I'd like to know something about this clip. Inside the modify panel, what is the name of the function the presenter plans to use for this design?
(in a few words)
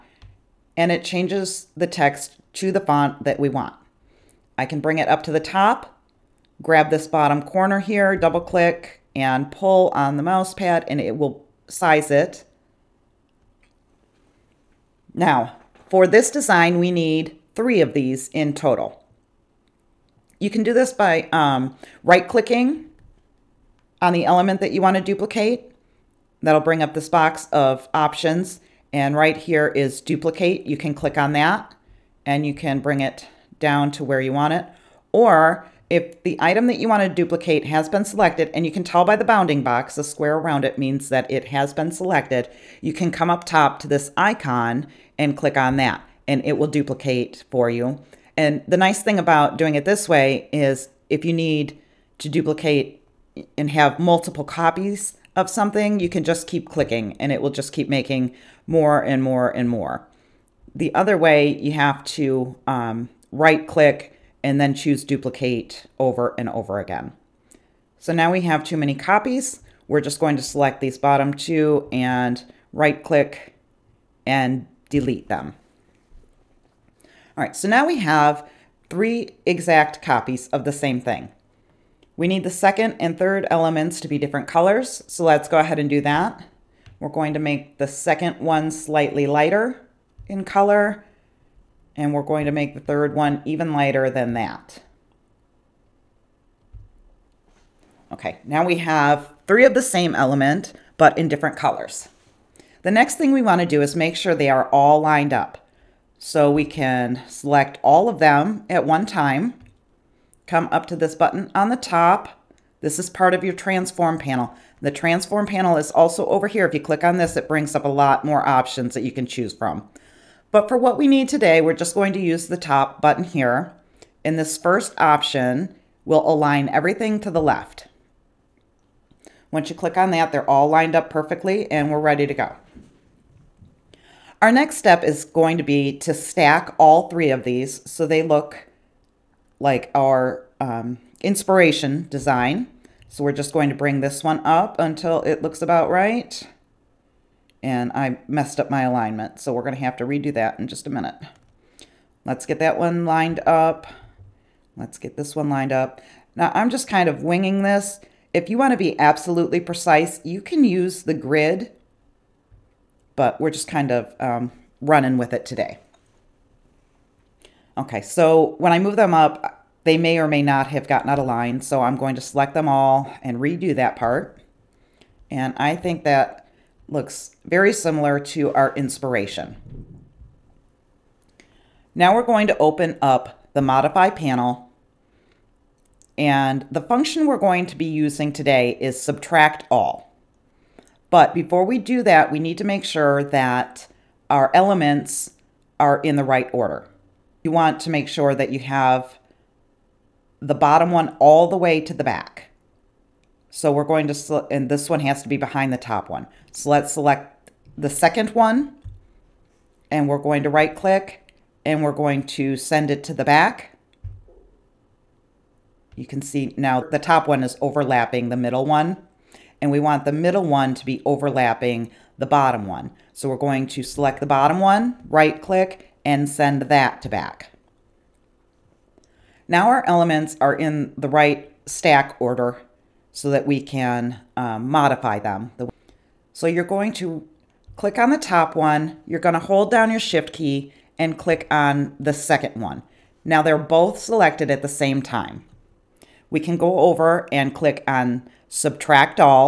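subtract all.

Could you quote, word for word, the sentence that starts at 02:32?
Let's get that one lined up.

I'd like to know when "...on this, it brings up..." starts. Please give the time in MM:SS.
01:57.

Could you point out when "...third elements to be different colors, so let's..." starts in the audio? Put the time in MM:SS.
01:23.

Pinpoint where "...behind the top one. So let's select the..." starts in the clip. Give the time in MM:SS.
03:25.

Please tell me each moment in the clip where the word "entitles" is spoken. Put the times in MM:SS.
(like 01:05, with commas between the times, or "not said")
not said.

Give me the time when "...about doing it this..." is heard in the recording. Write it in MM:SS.
00:49.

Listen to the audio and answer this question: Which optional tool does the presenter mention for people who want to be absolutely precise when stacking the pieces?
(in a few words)
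the grid.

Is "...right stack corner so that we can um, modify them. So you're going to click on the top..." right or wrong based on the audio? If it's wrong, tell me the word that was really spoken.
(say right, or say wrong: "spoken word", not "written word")
wrong: "order", not "corner".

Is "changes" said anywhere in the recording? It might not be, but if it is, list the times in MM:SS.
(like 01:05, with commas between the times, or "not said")
00:01.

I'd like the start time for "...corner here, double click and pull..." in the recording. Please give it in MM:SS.
00:07.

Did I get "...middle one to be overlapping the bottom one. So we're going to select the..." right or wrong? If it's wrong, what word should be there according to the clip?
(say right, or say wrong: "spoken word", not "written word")
right.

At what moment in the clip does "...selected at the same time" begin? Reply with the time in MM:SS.
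04:03.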